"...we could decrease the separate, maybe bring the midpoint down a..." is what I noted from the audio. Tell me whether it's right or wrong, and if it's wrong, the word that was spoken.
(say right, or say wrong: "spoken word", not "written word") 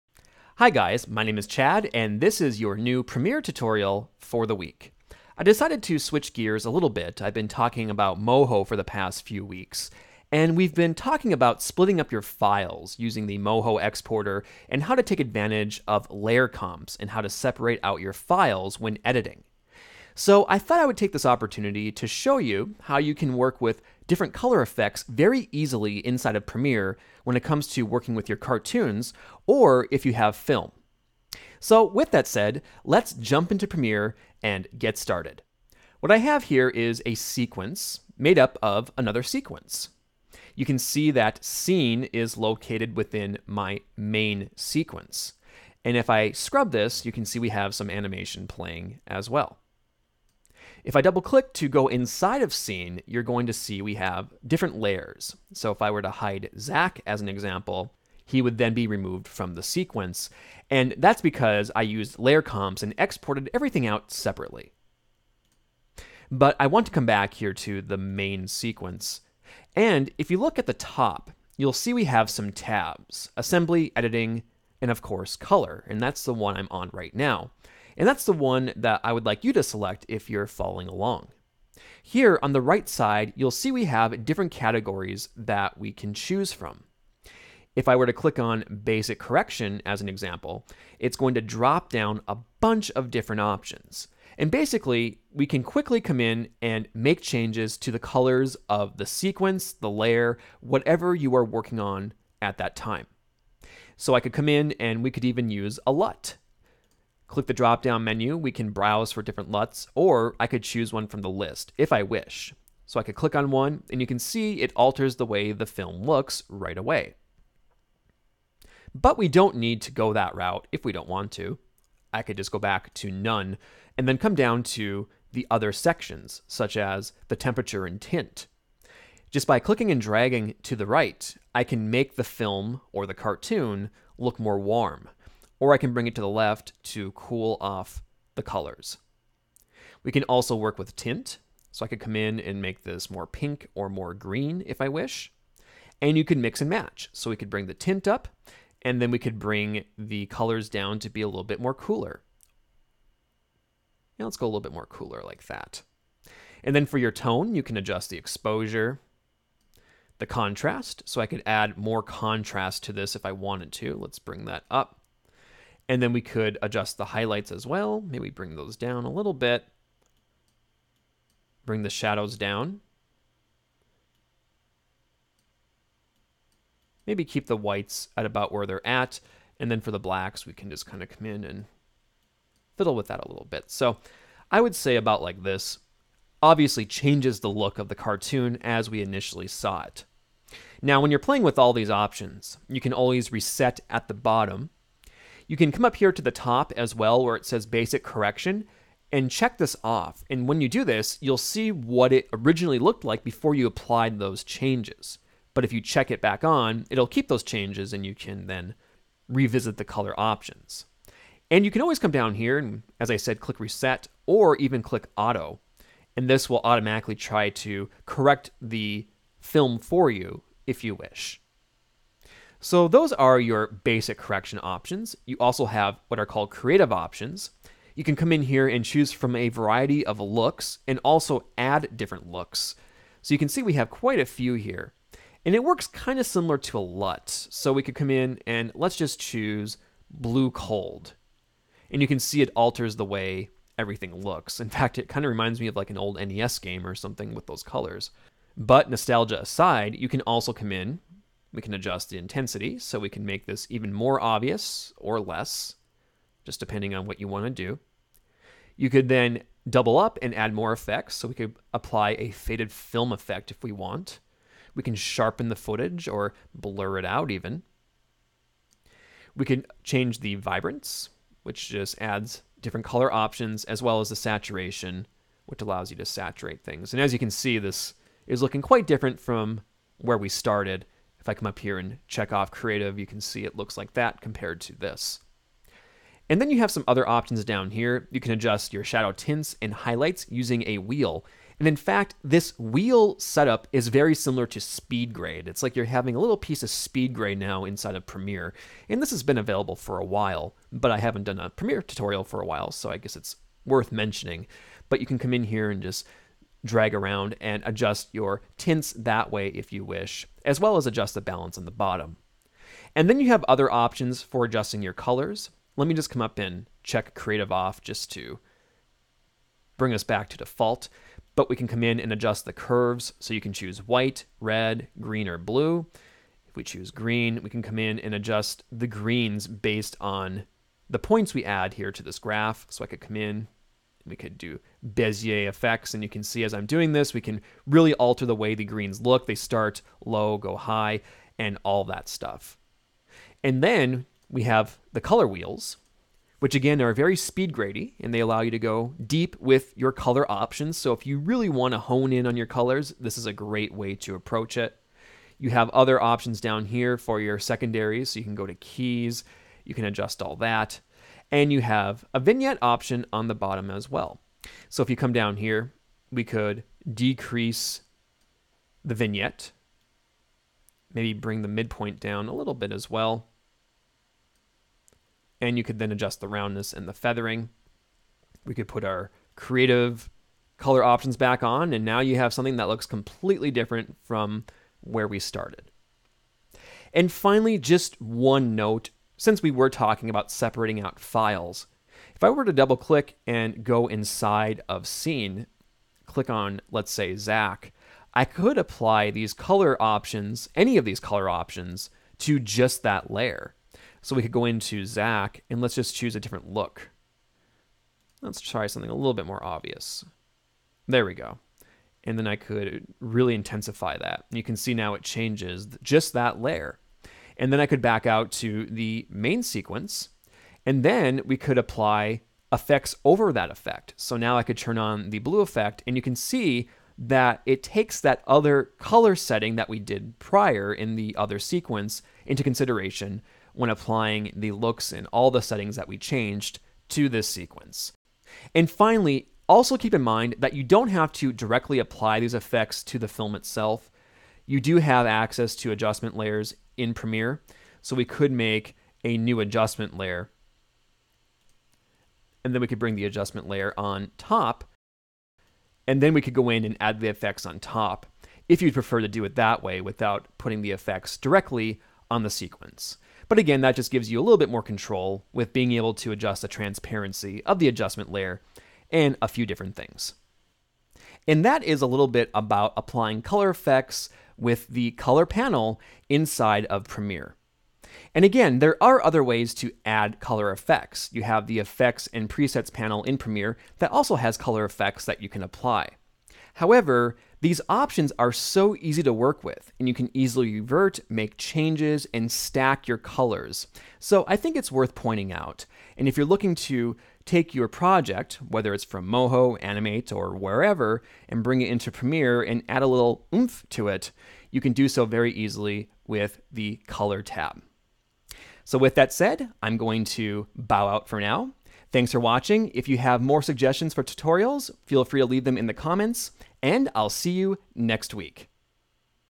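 wrong: "vignette", not "separate".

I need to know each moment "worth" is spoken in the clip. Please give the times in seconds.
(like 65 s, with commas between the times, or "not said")
303 s, 494 s.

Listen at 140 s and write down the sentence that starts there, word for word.
We can also work with tint, so I could come in and make this more pink or more green if I wish.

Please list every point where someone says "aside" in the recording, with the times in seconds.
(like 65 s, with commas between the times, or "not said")
249 s.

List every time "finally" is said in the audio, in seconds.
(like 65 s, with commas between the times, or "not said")
387 s, 438 s.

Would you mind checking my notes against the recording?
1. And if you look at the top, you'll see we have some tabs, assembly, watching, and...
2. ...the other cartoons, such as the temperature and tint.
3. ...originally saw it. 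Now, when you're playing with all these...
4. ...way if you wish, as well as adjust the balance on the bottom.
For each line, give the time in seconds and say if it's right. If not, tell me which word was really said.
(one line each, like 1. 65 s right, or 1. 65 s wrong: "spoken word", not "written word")
1. 69 s wrong: "editing", not "watching"
2. 125 s wrong: "sections", not "cartoons"
3. 189 s wrong: "initially", not "originally"
4. 309 s right.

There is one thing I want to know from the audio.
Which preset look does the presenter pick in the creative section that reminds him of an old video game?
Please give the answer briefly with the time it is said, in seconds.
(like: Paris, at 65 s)
Blue cold, at 240 s.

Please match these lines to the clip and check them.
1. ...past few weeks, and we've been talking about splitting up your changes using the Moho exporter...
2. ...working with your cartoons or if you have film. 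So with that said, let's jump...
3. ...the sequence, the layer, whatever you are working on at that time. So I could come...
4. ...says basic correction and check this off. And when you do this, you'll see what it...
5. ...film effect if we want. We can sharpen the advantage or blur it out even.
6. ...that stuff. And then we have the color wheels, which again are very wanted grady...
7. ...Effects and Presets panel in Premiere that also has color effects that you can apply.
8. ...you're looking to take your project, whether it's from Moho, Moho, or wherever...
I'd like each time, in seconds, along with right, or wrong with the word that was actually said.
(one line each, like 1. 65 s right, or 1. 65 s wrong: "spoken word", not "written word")
1. 8 s wrong: "files", not "changes"
2. 27 s right
3. 98 s right
4. 197 s right
5. 262 s wrong: "footage", not "advantage"
6. 341 s wrong: "speed", not "wanted"
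7. 481 s right
8. 496 s wrong: "Animate", not "Moho".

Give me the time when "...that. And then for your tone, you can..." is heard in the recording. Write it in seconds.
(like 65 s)
155 s.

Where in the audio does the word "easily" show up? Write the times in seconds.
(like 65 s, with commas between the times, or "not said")
25 s, 490 s, 505 s.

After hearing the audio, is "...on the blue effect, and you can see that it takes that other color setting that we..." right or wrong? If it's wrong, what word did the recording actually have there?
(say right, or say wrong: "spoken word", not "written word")
right.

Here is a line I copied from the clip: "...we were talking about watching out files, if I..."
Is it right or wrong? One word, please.
wrong.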